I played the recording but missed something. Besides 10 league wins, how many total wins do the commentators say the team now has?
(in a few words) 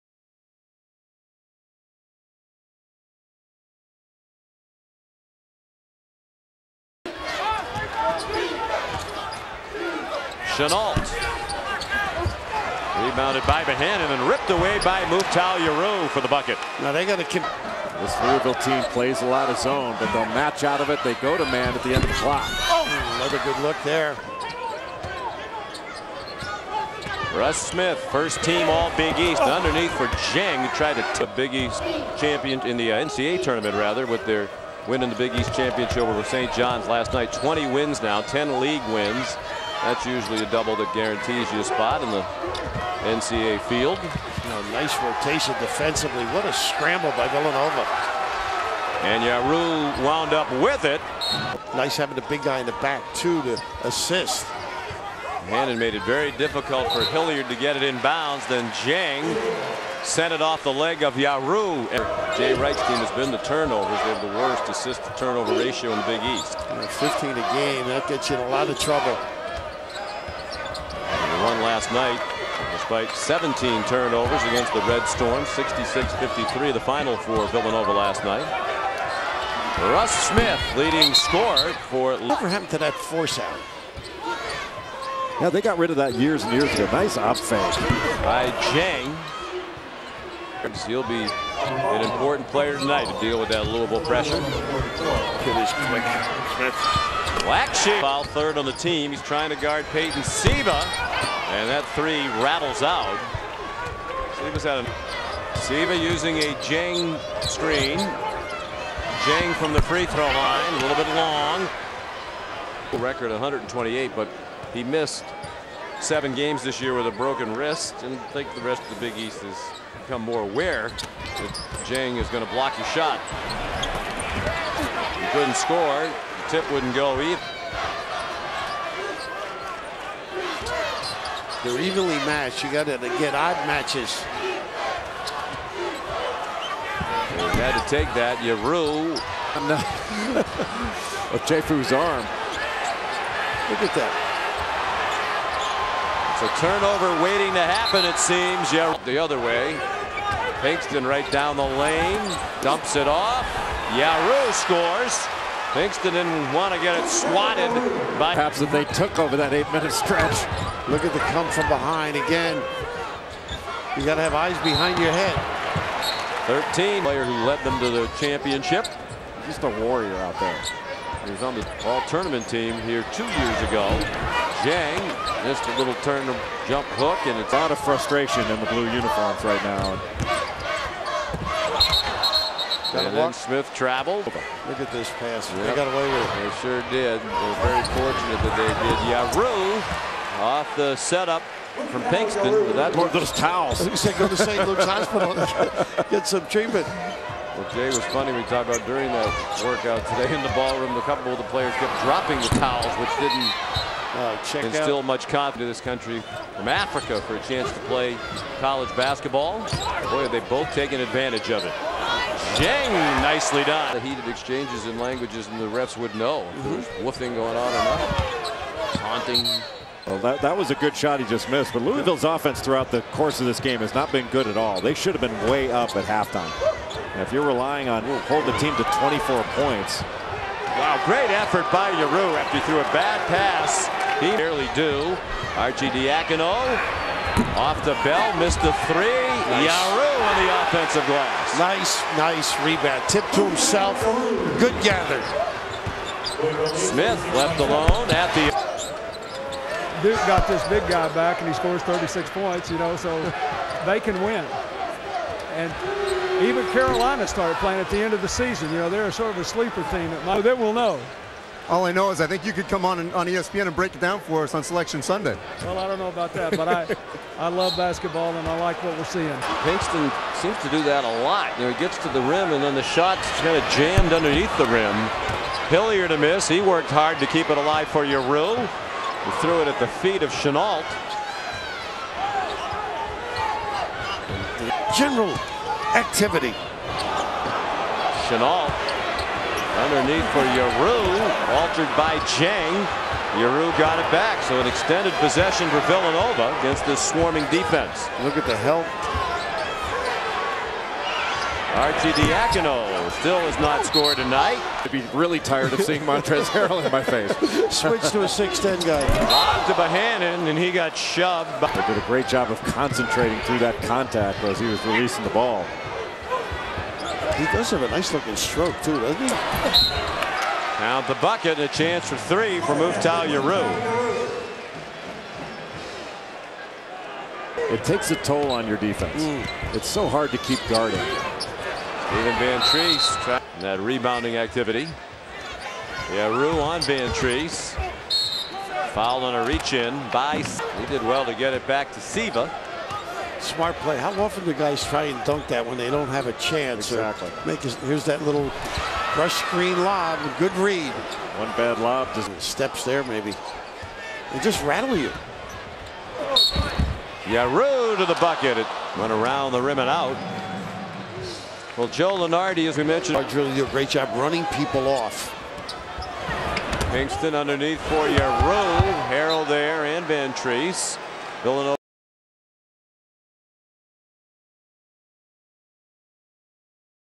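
20.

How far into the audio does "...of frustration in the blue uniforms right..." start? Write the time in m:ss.
2:57.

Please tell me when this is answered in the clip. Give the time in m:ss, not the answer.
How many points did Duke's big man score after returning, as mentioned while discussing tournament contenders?
4:11.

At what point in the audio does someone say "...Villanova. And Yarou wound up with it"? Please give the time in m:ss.
0:47.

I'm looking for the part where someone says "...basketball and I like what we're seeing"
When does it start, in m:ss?
4:27.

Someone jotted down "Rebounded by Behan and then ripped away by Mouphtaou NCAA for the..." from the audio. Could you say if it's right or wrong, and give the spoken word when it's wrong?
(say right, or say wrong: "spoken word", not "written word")
wrong: "Yarou", not "NCAA".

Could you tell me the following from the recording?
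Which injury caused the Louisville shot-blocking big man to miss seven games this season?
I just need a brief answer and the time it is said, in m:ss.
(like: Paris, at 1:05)
Broken wrist, at 1:57.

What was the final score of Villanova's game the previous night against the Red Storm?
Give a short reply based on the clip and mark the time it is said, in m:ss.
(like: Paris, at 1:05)
66-53, at 1:15.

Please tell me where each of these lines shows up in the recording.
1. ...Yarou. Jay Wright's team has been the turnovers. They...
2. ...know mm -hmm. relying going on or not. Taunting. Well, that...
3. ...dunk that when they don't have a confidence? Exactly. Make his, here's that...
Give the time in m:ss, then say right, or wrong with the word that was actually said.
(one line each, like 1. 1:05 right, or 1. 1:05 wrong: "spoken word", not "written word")
1. 1:01 right
2. 3:36 wrong: "woofing", not "relying"
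3. 5:45 wrong: "chance", not "confidence".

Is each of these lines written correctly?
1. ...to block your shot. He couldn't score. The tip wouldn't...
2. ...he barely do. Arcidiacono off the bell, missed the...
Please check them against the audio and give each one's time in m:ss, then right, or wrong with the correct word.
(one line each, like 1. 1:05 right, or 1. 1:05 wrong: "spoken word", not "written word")
1. 2:02 right
2. 3:54 right.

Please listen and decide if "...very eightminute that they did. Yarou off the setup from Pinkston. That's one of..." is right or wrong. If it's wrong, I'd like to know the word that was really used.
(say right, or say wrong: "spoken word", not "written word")
wrong: "fortunate", not "eightminute".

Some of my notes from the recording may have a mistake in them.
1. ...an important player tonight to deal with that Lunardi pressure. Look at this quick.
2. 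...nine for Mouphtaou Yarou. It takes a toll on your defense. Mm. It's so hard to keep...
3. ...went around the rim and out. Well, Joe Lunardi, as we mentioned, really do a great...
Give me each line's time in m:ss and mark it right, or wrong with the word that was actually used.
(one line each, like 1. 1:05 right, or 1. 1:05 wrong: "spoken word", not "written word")
1. 1:31 wrong: "Louisville", not "Lunardi"
2. 5:22 wrong: "three", not "nine"
3. 5:58 right.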